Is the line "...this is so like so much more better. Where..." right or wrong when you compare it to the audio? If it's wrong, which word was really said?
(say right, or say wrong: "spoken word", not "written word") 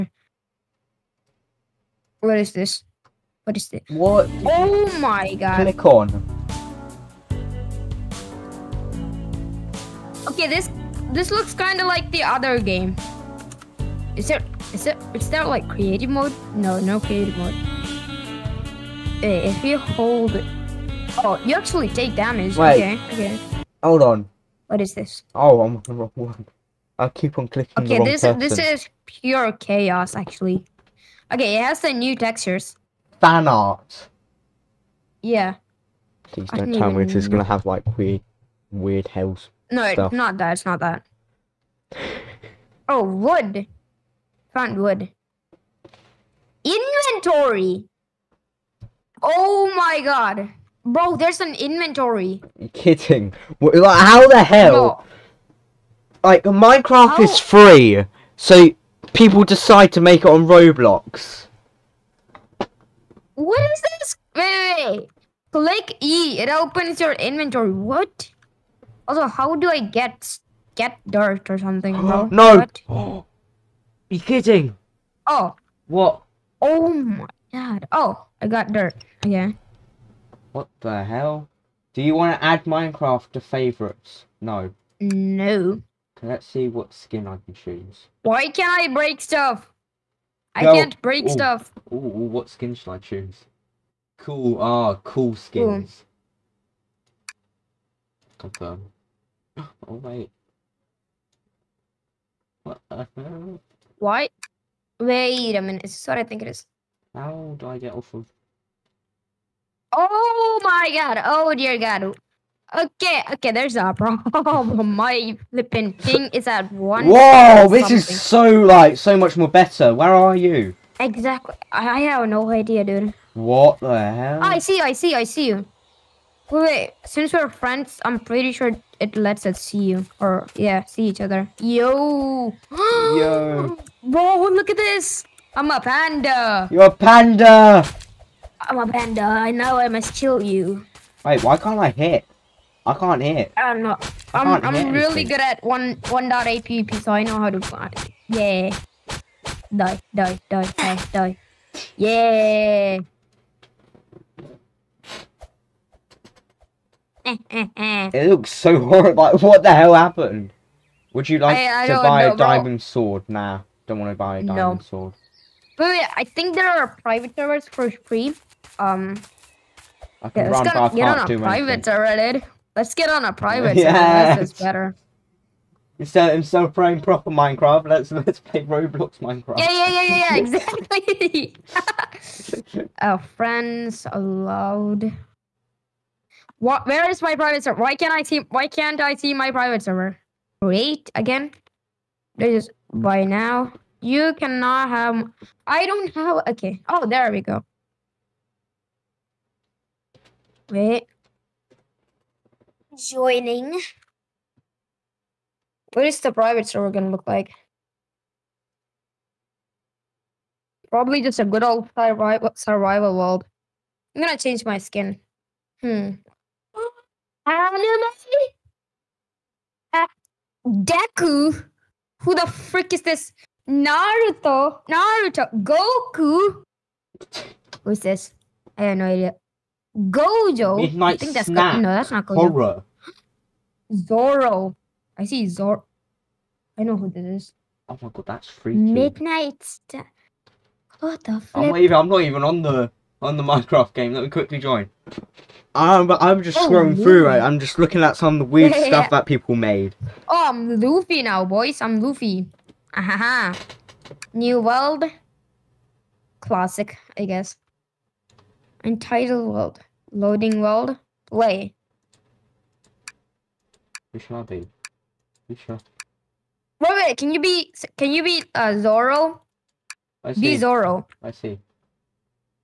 right.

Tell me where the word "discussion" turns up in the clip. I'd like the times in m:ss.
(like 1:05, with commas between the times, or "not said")
not said.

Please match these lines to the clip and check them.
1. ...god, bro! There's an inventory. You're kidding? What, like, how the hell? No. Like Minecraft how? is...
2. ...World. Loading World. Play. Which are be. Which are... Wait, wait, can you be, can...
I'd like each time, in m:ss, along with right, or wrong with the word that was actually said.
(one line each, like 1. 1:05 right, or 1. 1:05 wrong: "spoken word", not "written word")
1. 0:50 right
2. 4:19 right.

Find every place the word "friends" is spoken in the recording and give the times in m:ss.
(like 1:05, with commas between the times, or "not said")
2:07, 3:03.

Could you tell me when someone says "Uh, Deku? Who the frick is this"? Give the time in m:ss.
3:39.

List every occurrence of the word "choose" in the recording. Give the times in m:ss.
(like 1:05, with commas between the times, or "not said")
1:27, 1:32.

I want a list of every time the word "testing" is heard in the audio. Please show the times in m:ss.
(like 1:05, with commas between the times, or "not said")
not said.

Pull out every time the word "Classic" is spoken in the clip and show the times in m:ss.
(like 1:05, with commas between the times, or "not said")
4:16.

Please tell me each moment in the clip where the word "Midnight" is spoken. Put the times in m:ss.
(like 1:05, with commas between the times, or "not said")
3:50, 3:58.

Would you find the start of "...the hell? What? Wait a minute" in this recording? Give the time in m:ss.
1:42.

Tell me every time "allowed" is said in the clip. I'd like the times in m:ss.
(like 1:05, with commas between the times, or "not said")
3:04.